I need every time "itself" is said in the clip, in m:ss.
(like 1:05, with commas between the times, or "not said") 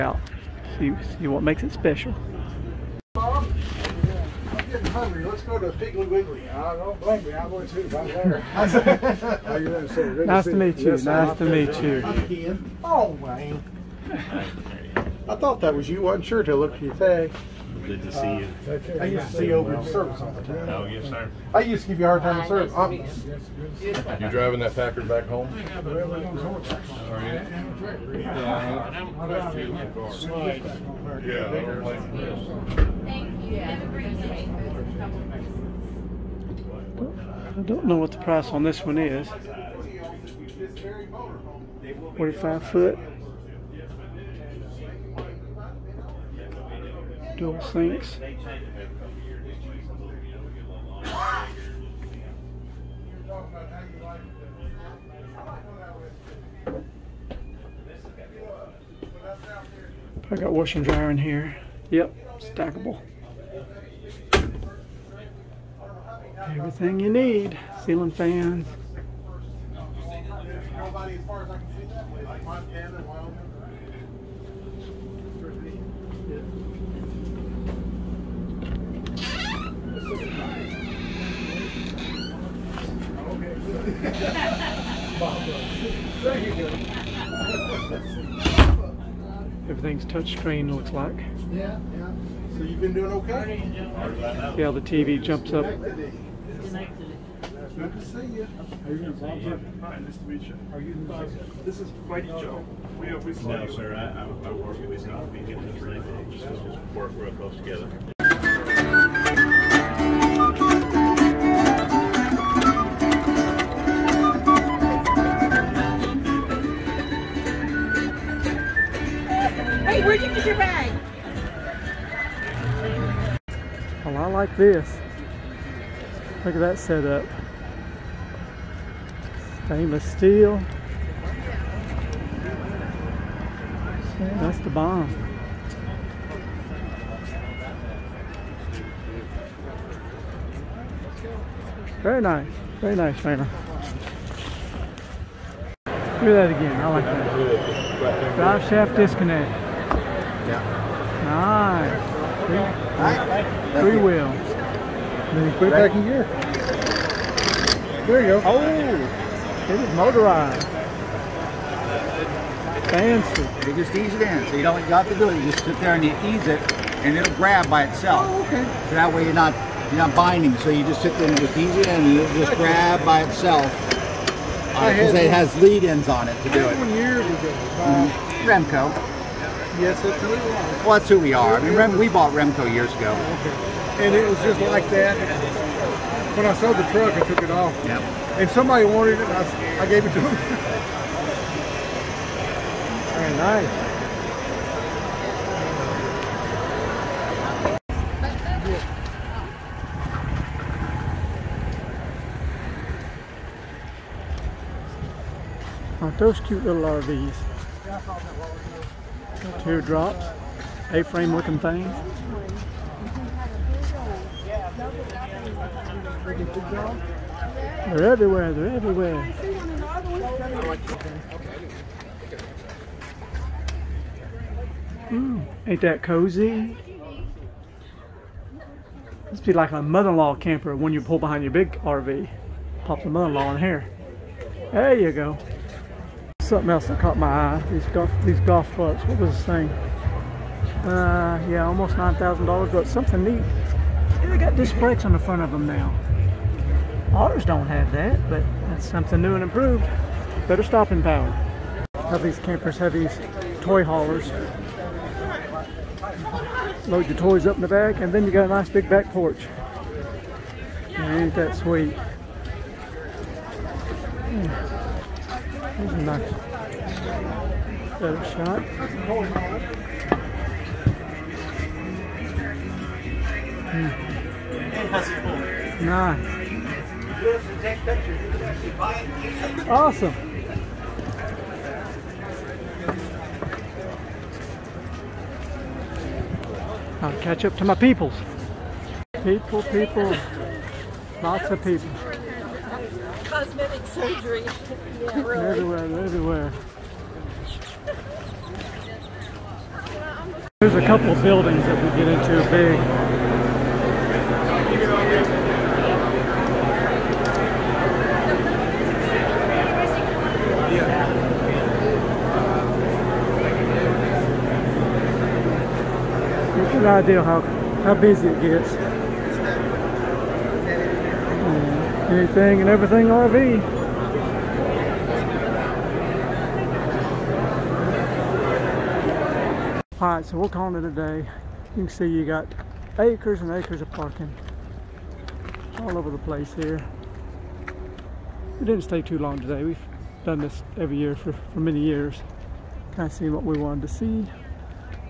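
2:47, 2:53.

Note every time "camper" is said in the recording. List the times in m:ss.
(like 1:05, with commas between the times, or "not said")
3:50, 4:12.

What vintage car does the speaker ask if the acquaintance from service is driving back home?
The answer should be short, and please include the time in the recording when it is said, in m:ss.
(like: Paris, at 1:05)
Packard, at 0:24.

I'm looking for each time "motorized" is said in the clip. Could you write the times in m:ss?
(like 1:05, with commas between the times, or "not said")
2:39.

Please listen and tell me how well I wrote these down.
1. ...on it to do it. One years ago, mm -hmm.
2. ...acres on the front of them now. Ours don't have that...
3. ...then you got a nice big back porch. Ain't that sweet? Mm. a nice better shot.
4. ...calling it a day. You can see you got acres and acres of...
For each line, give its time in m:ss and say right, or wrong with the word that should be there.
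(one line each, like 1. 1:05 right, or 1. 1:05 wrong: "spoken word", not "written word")
1. 2:56 right
2. 4:04 wrong: "brakes", not "acres"
3. 4:18 right
4. 5:30 right.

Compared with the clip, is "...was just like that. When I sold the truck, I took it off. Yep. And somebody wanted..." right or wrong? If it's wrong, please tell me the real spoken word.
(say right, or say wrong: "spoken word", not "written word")
right.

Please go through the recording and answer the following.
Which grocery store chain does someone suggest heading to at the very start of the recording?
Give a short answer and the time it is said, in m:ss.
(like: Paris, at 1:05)
Piggly Wiggly, at 0:05.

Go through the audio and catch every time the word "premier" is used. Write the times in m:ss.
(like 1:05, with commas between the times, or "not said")
not said.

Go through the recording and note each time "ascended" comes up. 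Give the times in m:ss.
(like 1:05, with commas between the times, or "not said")
not said.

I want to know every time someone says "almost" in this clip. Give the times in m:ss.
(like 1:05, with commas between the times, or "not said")
4:01.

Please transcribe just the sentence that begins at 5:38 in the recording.
We didn't stay too long today.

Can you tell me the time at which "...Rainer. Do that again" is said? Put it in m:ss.
2:23.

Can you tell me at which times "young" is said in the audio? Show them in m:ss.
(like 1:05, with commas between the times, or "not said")
not said.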